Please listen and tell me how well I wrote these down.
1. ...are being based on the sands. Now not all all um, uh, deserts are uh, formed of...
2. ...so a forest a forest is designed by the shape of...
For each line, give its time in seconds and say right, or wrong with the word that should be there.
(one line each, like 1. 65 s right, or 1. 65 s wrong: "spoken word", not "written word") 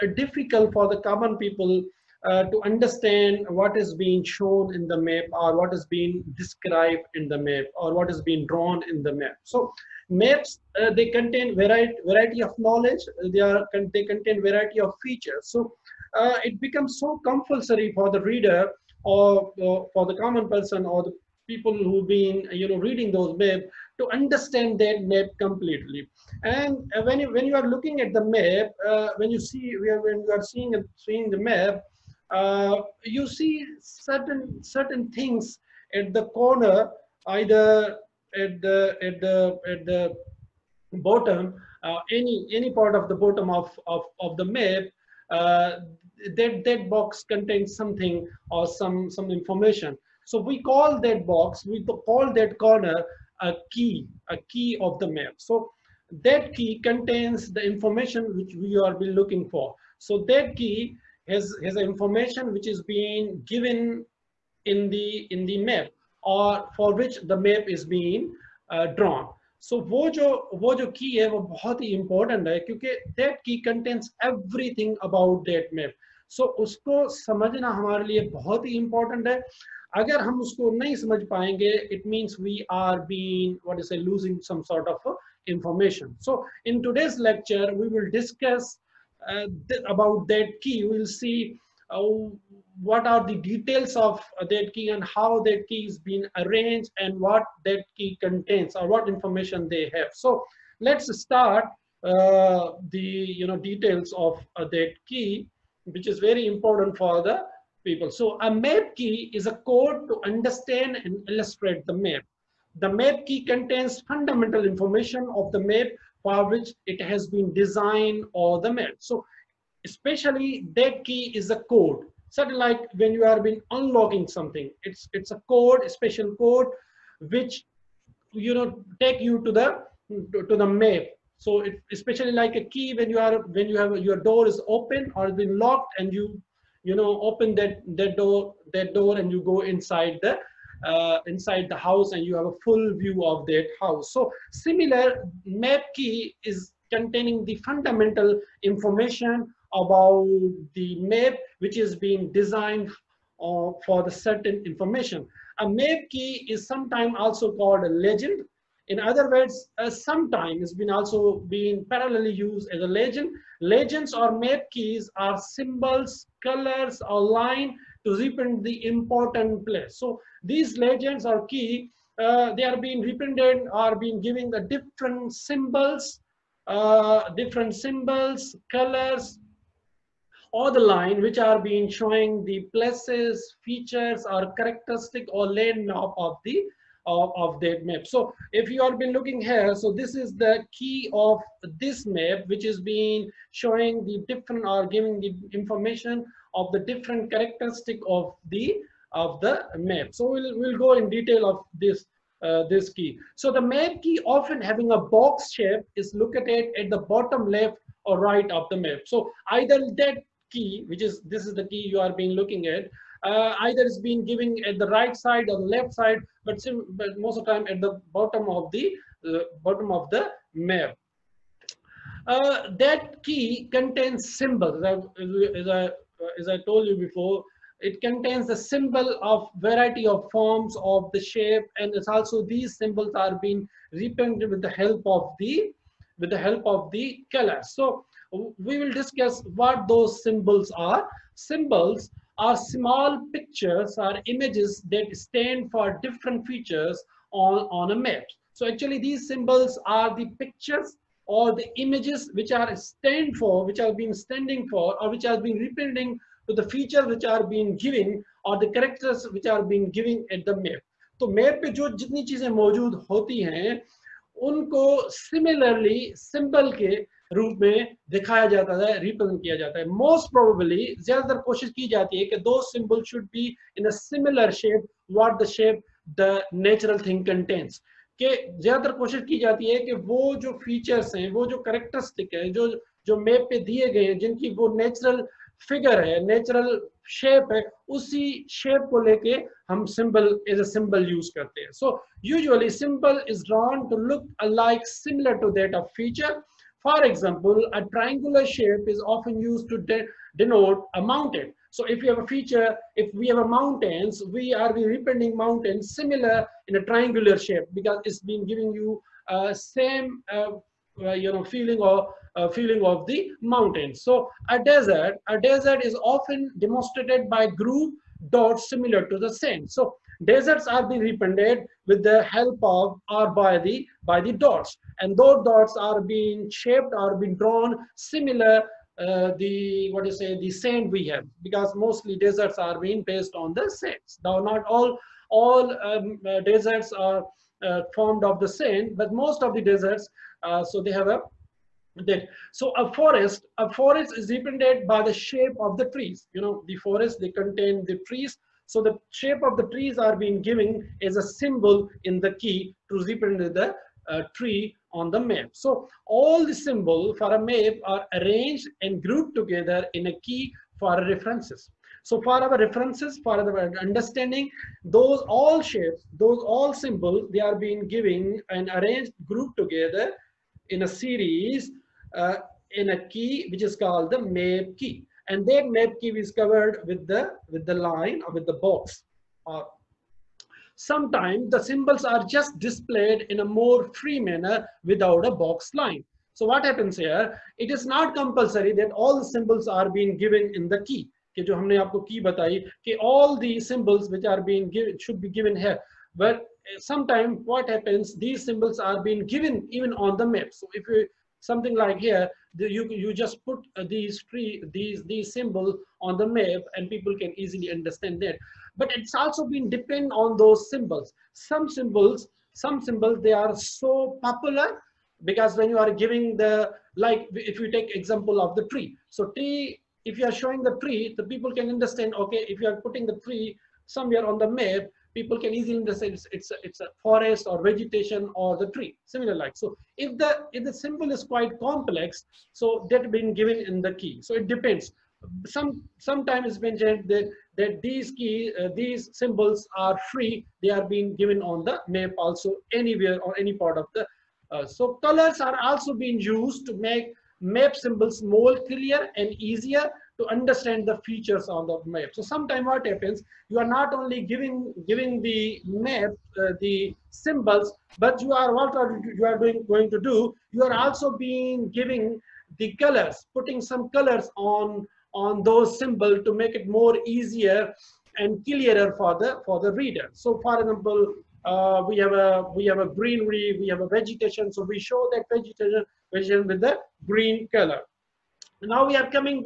1. 332 s right
2. 342 s wrong: "represented", not "designed".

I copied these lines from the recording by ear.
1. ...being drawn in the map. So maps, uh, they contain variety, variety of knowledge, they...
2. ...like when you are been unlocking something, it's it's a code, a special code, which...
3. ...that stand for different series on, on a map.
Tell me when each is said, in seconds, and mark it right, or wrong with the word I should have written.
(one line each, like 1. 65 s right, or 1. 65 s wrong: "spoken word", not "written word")
1. 8 s right
2. 122 s right
3. 244 s wrong: "features", not "series".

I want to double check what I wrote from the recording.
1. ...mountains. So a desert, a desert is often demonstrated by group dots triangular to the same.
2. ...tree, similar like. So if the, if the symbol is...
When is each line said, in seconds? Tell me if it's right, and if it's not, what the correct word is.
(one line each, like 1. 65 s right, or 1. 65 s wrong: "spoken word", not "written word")
1. 313 s wrong: "similar", not "triangular"
2. 428 s right.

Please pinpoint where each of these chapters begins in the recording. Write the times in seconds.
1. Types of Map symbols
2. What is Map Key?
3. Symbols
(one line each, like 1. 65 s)
1. 469 s
2. 108 s
3. 223 s.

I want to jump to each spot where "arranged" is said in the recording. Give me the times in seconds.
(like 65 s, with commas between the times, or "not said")
96 s, 358 s, 368 s.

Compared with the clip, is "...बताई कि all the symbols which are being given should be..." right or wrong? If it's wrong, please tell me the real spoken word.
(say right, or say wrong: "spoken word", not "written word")
right.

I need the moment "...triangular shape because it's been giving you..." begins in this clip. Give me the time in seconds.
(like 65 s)
306 s.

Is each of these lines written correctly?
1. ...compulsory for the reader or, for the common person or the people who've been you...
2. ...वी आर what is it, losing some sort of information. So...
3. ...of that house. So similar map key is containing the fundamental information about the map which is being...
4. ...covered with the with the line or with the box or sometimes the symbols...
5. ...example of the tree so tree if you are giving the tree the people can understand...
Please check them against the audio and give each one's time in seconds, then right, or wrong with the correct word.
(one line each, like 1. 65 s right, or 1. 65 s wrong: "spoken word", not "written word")
1. 17 s right
2. 82 s right
3. 143 s right
4. 376 s right
5. 417 s wrong: "showing", not "giving".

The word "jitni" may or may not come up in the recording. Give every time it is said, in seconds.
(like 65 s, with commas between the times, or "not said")
261 s.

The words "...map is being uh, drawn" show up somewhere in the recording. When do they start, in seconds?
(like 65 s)
67 s.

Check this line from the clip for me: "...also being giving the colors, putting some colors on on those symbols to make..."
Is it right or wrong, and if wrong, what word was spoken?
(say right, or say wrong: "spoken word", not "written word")
right.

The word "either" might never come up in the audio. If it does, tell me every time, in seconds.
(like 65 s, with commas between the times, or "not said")
37 s, 209 s, 213 s.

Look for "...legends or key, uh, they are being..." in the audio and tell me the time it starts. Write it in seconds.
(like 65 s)
170 s.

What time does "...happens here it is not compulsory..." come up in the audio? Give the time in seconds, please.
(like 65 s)
386 s.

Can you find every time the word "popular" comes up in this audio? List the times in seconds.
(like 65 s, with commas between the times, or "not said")
414 s.